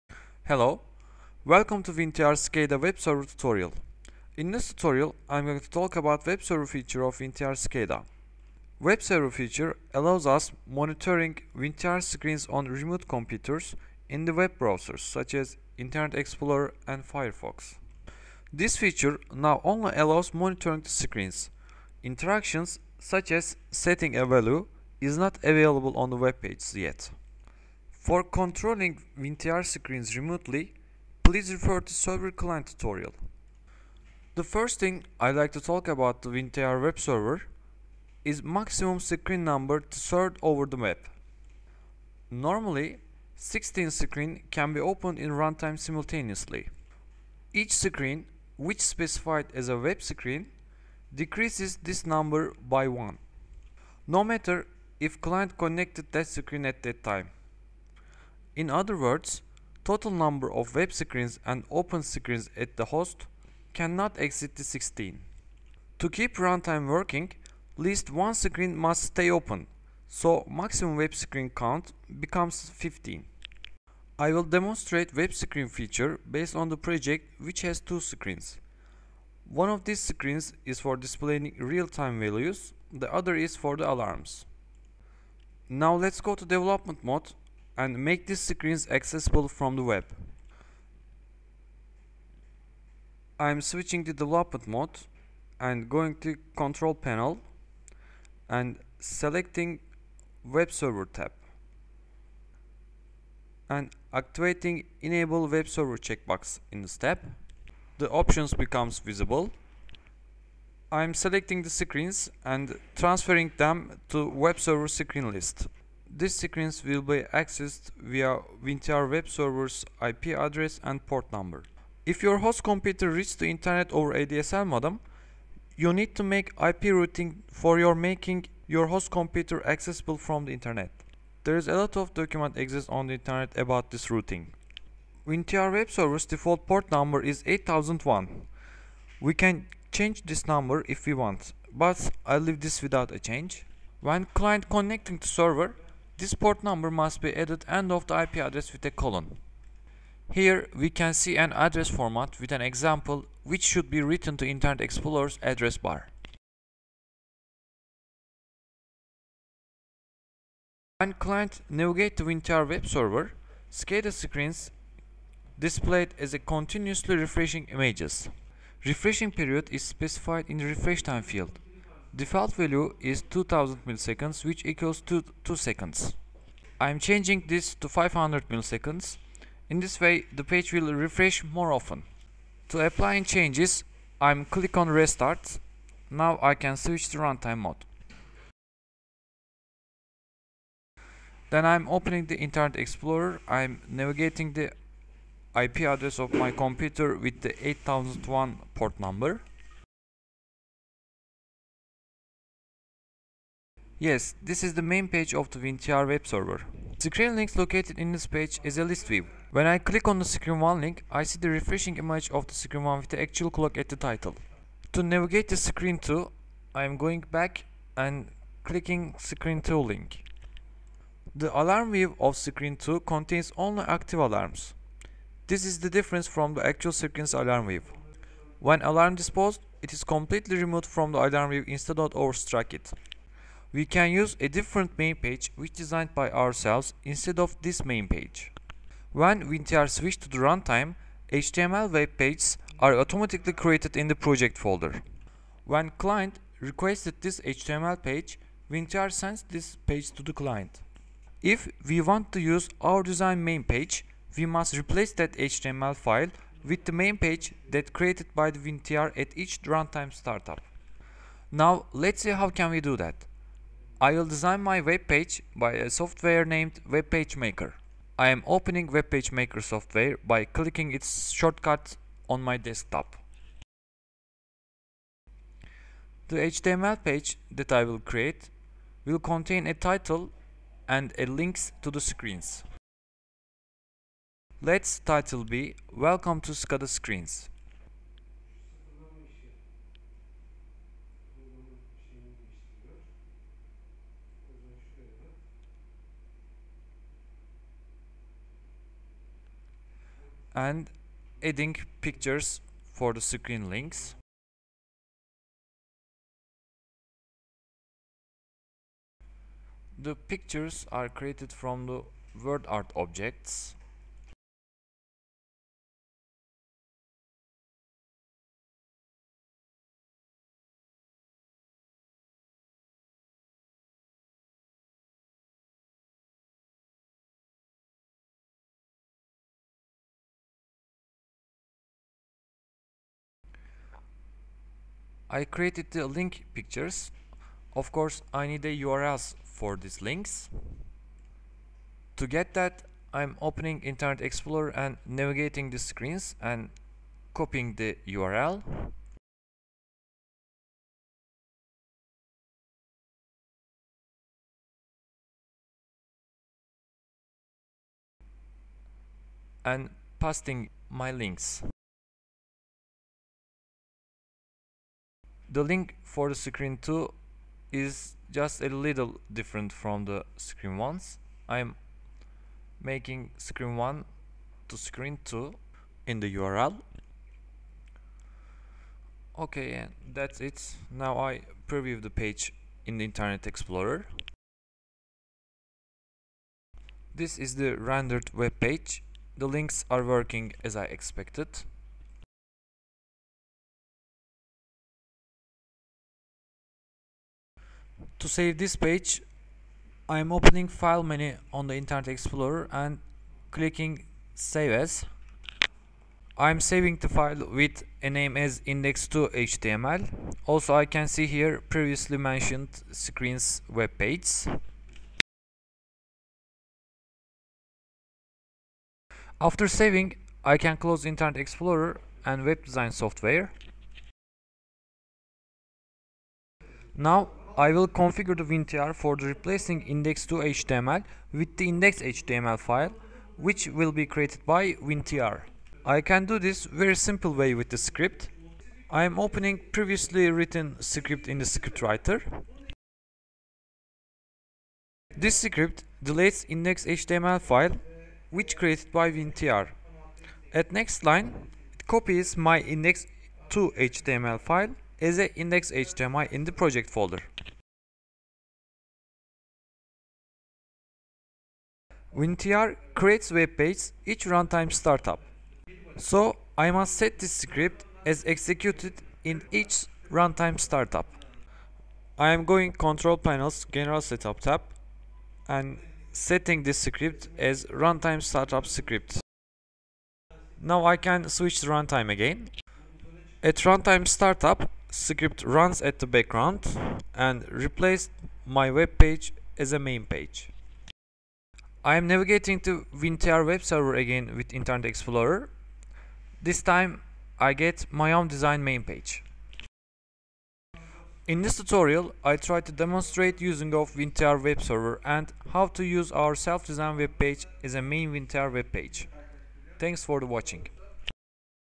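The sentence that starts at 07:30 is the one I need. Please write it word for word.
At next line, it copies my index 2 HTML file as a index.html in the project folder.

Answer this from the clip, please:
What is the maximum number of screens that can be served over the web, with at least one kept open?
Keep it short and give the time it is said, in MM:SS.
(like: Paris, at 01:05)
15, at 01:12.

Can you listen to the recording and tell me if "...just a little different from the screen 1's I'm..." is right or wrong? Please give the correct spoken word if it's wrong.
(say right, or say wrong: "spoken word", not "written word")
right.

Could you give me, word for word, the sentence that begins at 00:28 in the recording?
For controlling WinTR screens remotely, please refer to Server Client tutorial.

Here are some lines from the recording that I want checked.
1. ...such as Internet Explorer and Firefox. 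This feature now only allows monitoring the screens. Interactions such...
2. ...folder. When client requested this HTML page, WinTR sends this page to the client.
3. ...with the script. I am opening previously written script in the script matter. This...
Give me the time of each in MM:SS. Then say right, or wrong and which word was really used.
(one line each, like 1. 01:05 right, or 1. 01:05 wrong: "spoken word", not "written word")
1. 00:14 right
2. 04:04 right
3. 07:17 wrong: "writer", not "matter".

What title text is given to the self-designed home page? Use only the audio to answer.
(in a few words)
Welcome to SCADA Screens.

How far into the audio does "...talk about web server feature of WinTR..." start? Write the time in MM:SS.
00:05.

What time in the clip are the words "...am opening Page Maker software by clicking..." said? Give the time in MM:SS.
04:28.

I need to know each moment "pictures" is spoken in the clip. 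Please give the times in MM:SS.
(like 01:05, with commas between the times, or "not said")
05:02, 05:10, 05:36.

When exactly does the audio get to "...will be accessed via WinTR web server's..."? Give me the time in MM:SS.
01:56.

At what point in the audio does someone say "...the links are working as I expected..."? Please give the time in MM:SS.
06:29.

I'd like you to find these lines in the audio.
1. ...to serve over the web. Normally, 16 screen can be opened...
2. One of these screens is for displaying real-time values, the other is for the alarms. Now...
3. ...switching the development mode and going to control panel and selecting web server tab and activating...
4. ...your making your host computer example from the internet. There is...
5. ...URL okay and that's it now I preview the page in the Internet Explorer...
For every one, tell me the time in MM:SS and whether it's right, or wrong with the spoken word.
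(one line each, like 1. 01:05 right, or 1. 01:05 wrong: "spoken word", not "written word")
1. 00:39 right
2. 01:19 right
3. 01:33 right
4. 02:07 wrong: "accessible", not "example"
5. 06:16 right.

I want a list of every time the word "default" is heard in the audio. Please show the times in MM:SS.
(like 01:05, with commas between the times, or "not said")
02:16, 02:52.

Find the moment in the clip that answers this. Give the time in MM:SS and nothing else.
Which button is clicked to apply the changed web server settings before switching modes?
03:04.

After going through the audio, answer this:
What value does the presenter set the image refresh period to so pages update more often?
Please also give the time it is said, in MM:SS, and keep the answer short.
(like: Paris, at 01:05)
500 milliseconds, at 02:57.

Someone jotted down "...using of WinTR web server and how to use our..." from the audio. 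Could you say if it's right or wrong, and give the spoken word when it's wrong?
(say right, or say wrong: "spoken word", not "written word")
right.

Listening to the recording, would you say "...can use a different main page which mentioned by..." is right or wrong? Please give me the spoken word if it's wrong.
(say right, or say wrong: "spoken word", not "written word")
wrong: "designed", not "mentioned".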